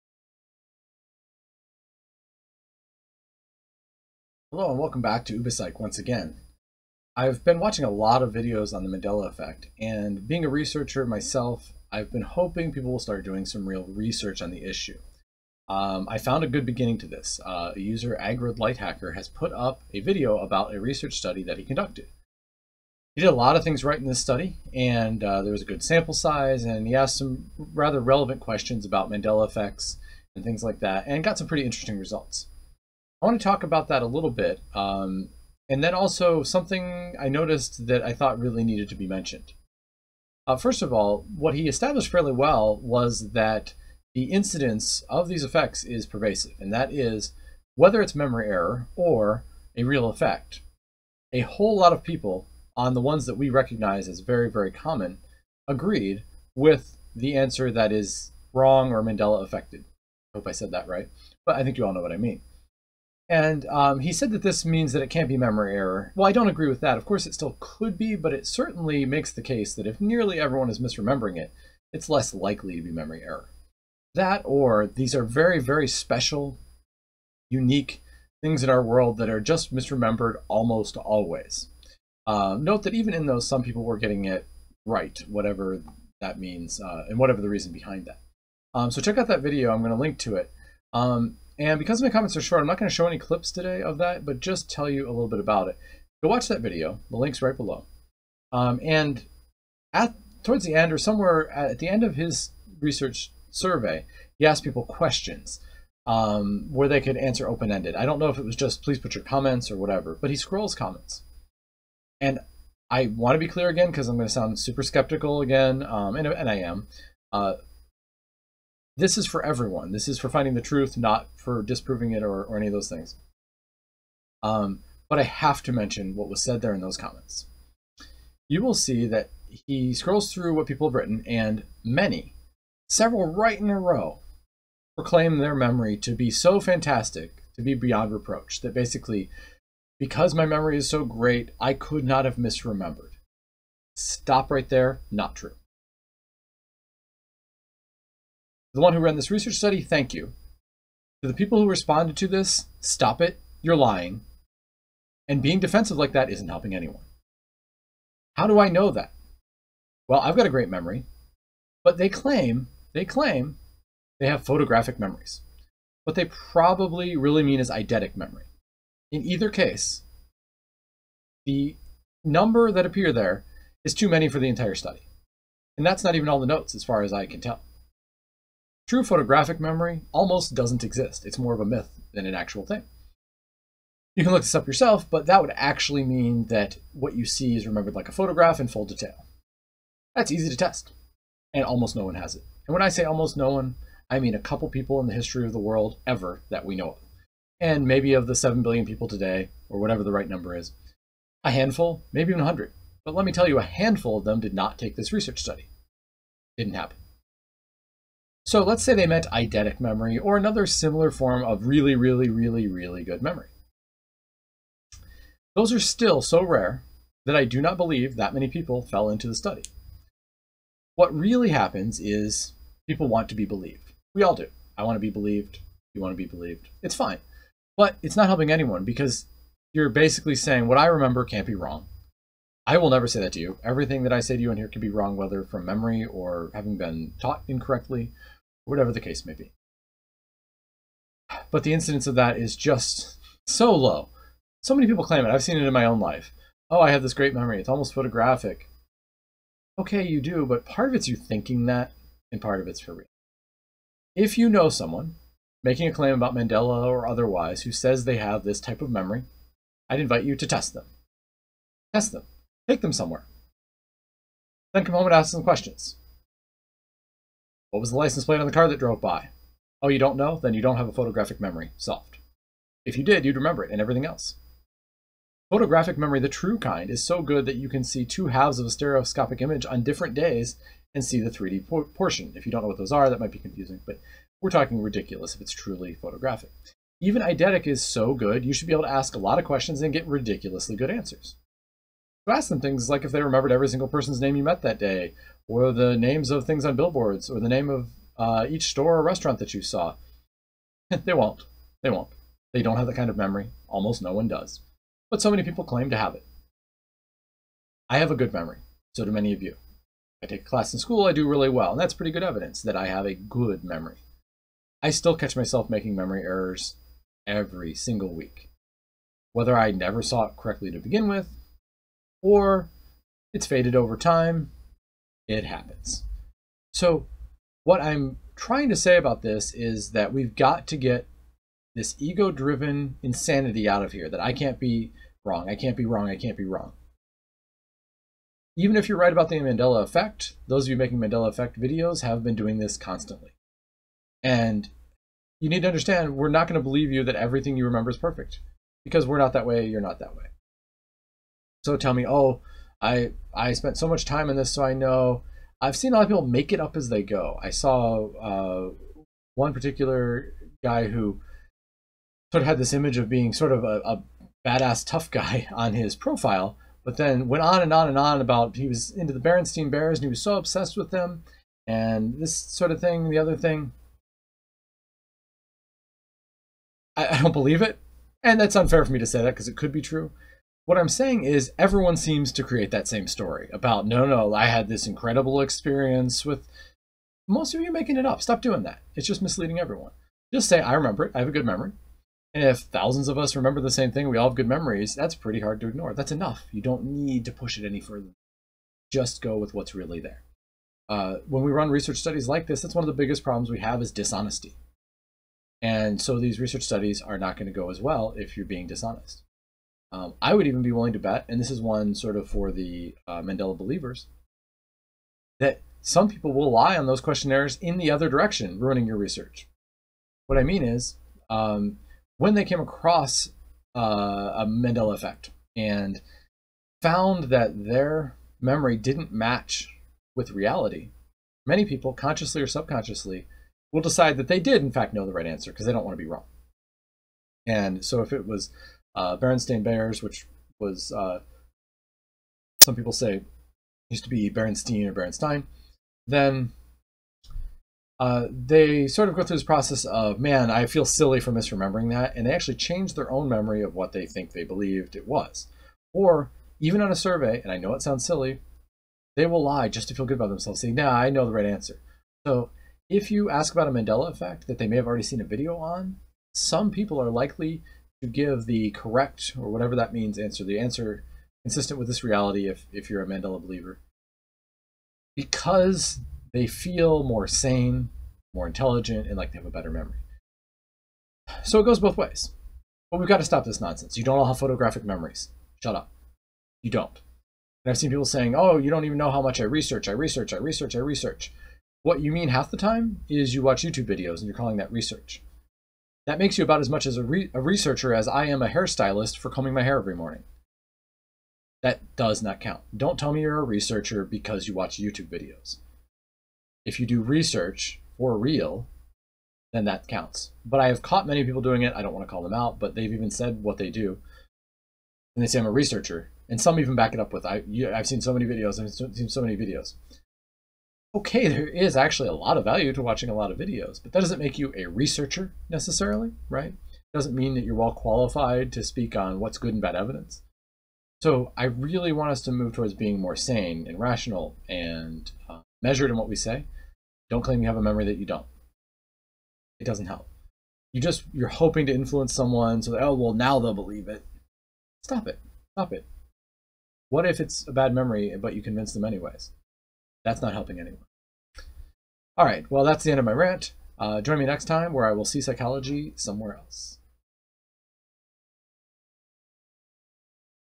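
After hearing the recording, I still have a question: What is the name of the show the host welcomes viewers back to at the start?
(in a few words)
Ubipsych.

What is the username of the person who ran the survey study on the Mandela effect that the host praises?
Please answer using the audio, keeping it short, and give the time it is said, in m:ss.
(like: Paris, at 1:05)
Aggroed Lighthacker, at 0:18.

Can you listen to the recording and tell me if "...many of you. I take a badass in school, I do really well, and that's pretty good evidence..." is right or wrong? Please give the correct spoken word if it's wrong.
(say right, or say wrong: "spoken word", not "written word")
wrong: "class", not "badass".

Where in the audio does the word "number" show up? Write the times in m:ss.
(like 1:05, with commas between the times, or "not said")
2:52, 3:20.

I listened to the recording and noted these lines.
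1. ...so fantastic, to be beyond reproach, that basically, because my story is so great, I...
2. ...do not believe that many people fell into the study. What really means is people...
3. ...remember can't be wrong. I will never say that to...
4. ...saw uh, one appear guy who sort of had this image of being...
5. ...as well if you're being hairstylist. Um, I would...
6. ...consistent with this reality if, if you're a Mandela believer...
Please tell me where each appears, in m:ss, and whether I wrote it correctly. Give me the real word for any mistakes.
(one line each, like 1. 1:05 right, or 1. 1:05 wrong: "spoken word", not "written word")
1. 2:16 wrong: "memory", not "story"
2. 3:37 wrong: "happens", not "means"
3. 3:50 right
4. 5:57 wrong: "particular", not "appear"
5. 6:47 wrong: "dishonest", not "hairstylist"
6. 7:51 right.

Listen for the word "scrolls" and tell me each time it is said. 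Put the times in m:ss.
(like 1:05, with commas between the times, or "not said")
1:50, 2:09.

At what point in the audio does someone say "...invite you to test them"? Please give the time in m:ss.
4:19.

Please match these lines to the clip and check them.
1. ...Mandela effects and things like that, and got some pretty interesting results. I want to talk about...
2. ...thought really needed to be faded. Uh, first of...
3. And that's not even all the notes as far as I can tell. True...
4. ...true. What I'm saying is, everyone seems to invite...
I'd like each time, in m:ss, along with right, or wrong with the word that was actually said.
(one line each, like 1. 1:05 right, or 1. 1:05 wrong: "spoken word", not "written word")
1. 0:29 right
2. 0:38 wrong: "mentioned", not "faded"
3. 2:55 right
4. 6:19 wrong: "create", not "invite".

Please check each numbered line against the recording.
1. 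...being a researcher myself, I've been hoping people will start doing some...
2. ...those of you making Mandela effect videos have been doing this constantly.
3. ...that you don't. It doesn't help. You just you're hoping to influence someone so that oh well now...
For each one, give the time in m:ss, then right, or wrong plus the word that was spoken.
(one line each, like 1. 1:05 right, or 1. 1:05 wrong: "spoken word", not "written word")
1. 0:10 right
2. 5:40 right
3. 8:57 right.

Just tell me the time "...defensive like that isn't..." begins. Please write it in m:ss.
2:35.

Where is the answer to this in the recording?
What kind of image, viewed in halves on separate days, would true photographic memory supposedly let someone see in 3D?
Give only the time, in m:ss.
4:38.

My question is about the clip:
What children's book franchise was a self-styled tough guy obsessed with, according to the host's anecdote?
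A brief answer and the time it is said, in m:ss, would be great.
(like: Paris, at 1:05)
Berenstein Bears, at 6:09.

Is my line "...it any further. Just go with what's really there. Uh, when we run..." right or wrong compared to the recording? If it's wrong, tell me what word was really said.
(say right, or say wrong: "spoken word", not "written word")
right.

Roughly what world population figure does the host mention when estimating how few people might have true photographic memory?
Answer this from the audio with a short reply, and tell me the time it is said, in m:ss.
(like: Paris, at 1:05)
7 billion, at 3:18.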